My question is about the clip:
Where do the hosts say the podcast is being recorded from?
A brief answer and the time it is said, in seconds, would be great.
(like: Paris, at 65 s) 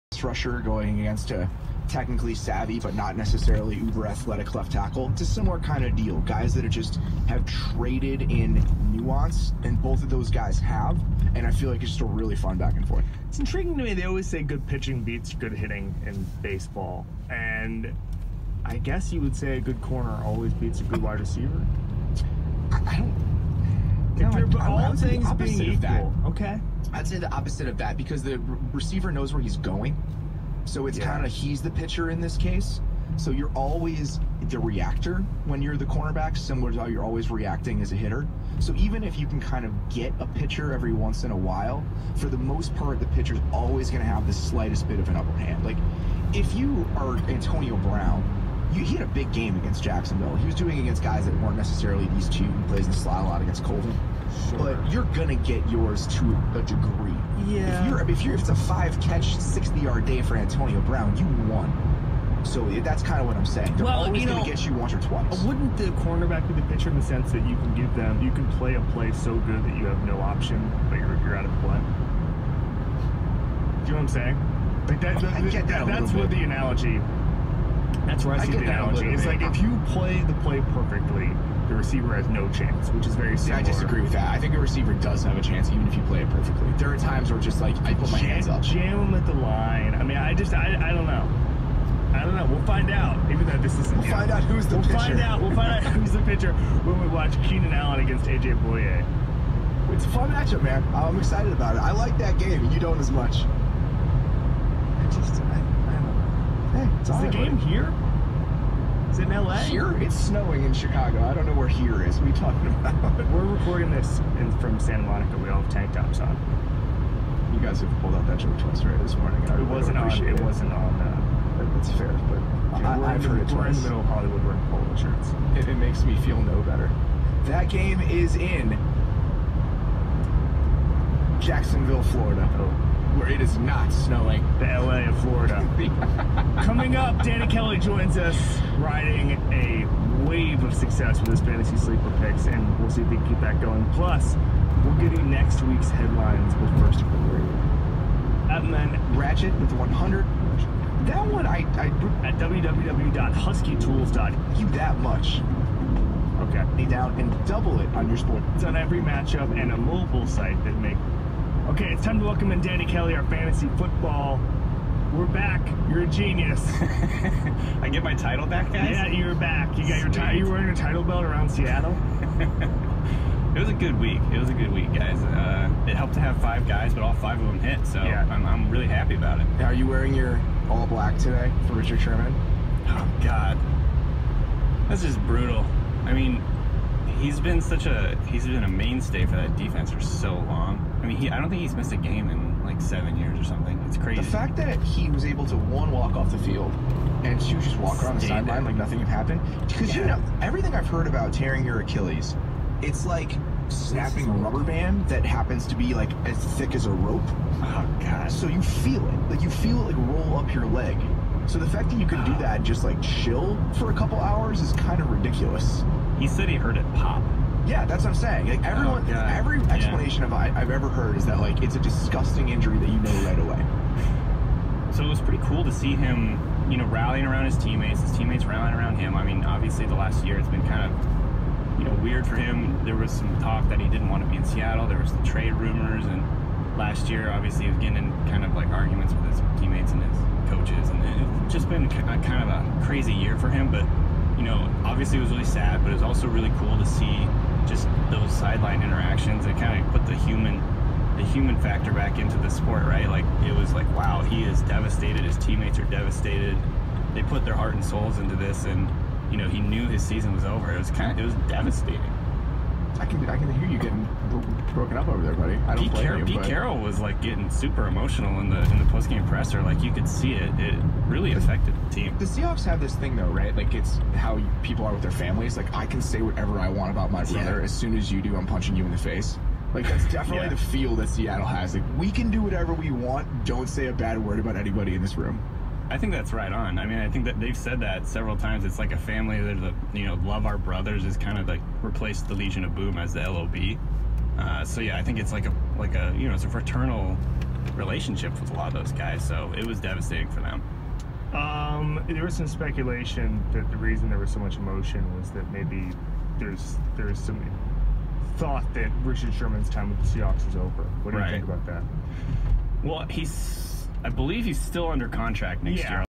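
Santa Monica, at 114 s.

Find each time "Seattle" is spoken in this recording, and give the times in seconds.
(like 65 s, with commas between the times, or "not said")
171 s, 234 s, 281 s.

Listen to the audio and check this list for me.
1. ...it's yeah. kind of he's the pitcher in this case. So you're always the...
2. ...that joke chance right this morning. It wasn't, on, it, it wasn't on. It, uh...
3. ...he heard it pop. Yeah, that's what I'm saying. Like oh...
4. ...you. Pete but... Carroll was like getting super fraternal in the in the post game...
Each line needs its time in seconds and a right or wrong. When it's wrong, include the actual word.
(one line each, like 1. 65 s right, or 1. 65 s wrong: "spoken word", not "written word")
1. 30 s right
2. 118 s wrong: "twice", not "chance"
3. 216 s right
4. 266 s wrong: "emotional", not "fraternal".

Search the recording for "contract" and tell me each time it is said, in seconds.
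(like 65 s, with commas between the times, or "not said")
315 s.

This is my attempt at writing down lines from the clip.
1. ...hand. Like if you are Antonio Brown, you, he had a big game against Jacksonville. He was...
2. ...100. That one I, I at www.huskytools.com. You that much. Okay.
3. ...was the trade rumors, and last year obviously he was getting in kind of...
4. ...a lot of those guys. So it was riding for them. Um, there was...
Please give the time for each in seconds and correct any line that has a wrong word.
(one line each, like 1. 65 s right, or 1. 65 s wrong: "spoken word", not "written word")
1. 45 s right
2. 149 s right
3. 234 s right
4. 298 s wrong: "devastating", not "riding".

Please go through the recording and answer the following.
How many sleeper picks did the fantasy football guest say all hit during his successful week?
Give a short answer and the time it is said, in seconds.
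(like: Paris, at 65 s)
5, at 176 s.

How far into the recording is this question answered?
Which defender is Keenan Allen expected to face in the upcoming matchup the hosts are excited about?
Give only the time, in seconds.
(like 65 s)
98 s.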